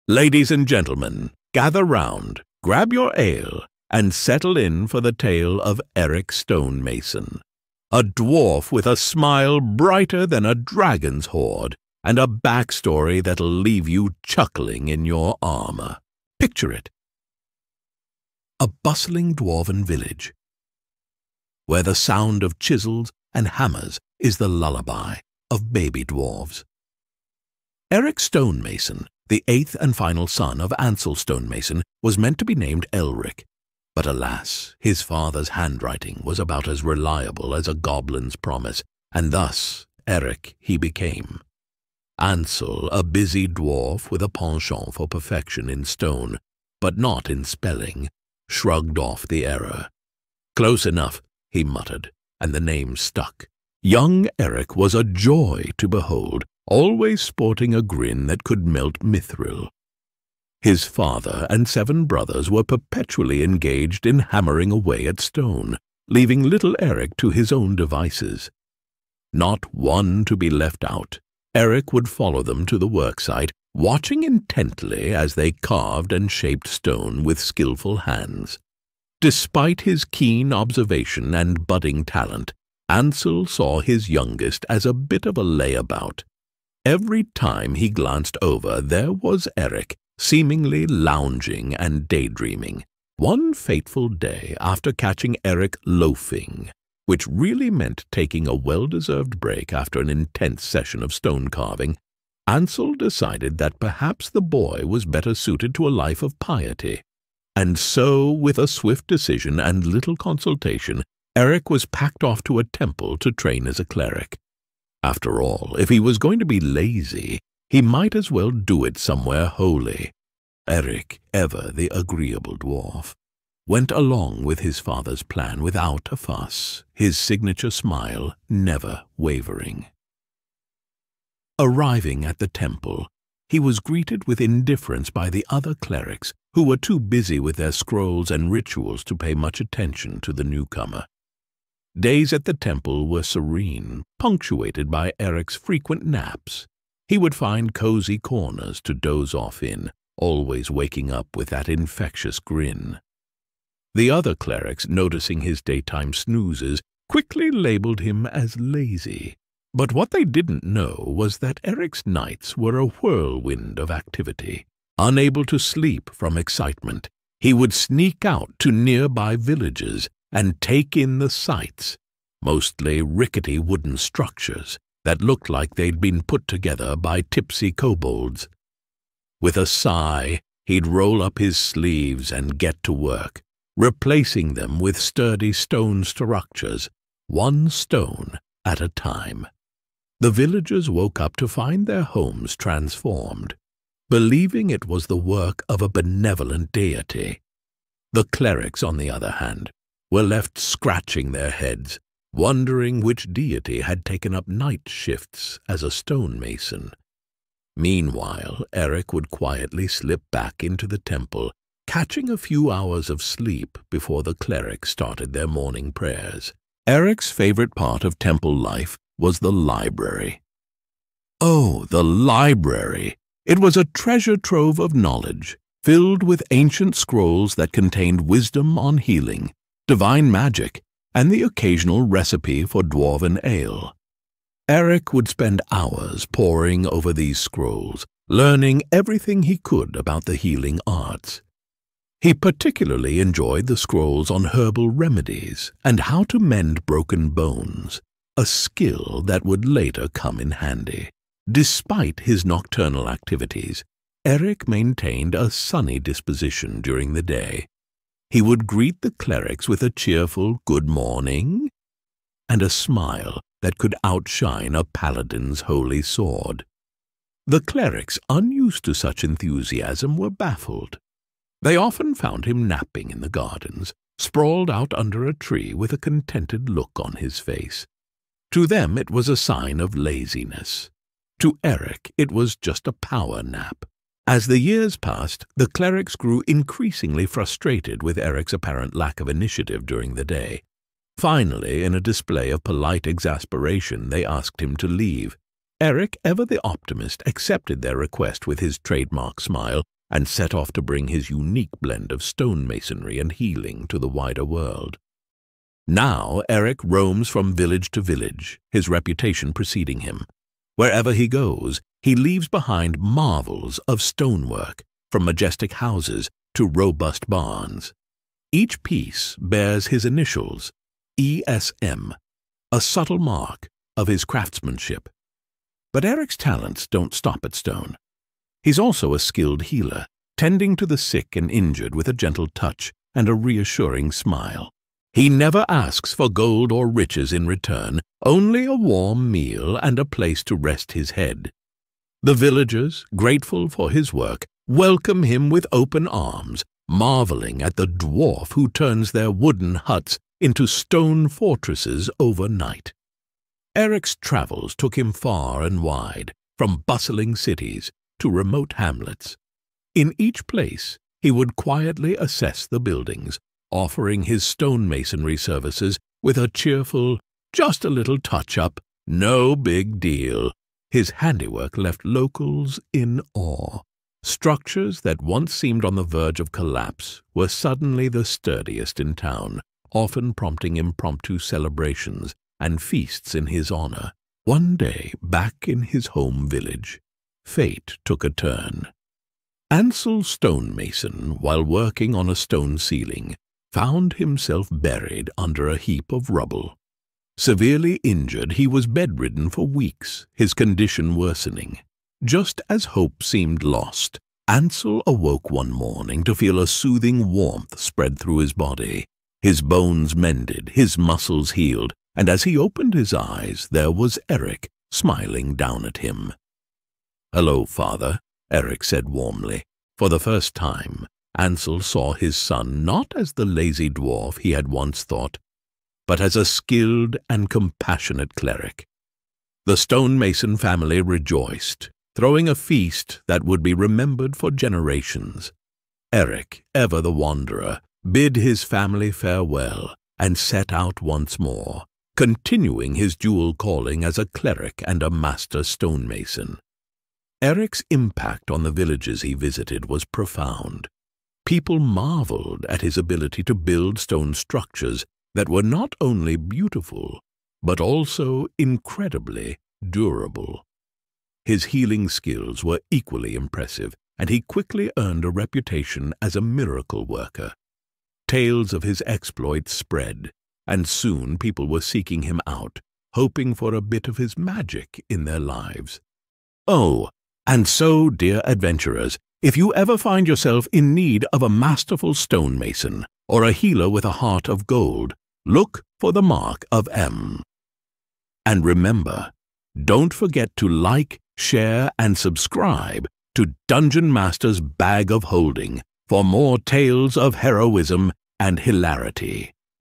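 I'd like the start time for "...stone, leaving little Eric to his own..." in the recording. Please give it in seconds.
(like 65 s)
65 s.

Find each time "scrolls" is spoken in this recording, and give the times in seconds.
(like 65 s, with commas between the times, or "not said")
137 s, 226 s, 237 s, 243 s.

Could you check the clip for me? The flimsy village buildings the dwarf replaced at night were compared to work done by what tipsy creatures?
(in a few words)
kobolds.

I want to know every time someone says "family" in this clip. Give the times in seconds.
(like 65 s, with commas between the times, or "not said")
430 s, 438 s.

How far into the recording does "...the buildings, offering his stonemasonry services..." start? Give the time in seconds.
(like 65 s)
362 s.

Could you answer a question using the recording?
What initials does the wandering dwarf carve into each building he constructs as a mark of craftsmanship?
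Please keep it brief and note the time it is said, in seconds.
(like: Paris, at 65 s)
ESM, at 321 s.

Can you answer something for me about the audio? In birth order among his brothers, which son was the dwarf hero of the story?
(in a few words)
eighth.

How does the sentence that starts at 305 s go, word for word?
Now Eric roams from village to village, his reputation preceding him.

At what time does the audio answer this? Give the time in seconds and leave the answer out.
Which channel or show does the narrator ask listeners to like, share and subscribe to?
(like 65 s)
493 s.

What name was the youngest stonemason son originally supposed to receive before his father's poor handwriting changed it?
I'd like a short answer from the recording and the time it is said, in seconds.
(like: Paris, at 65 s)
Elric, at 32 s.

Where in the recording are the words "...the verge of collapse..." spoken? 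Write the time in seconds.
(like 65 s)
375 s.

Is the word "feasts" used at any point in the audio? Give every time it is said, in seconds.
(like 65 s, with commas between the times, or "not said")
382 s, 432 s.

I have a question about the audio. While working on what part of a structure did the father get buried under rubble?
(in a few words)
stone ceiling.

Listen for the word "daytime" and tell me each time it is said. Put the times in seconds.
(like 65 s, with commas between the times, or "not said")
155 s.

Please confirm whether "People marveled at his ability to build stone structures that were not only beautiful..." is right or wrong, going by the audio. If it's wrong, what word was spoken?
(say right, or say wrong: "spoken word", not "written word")
right.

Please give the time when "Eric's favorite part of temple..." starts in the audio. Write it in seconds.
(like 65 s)
216 s.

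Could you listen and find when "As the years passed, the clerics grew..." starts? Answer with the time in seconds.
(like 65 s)
284 s.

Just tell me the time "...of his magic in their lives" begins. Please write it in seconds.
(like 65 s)
474 s.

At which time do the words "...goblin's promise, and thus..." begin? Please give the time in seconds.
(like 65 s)
37 s.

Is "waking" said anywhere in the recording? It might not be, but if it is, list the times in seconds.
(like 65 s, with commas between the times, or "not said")
150 s.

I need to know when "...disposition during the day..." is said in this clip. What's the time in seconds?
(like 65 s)
255 s.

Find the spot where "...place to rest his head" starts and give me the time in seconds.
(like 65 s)
340 s.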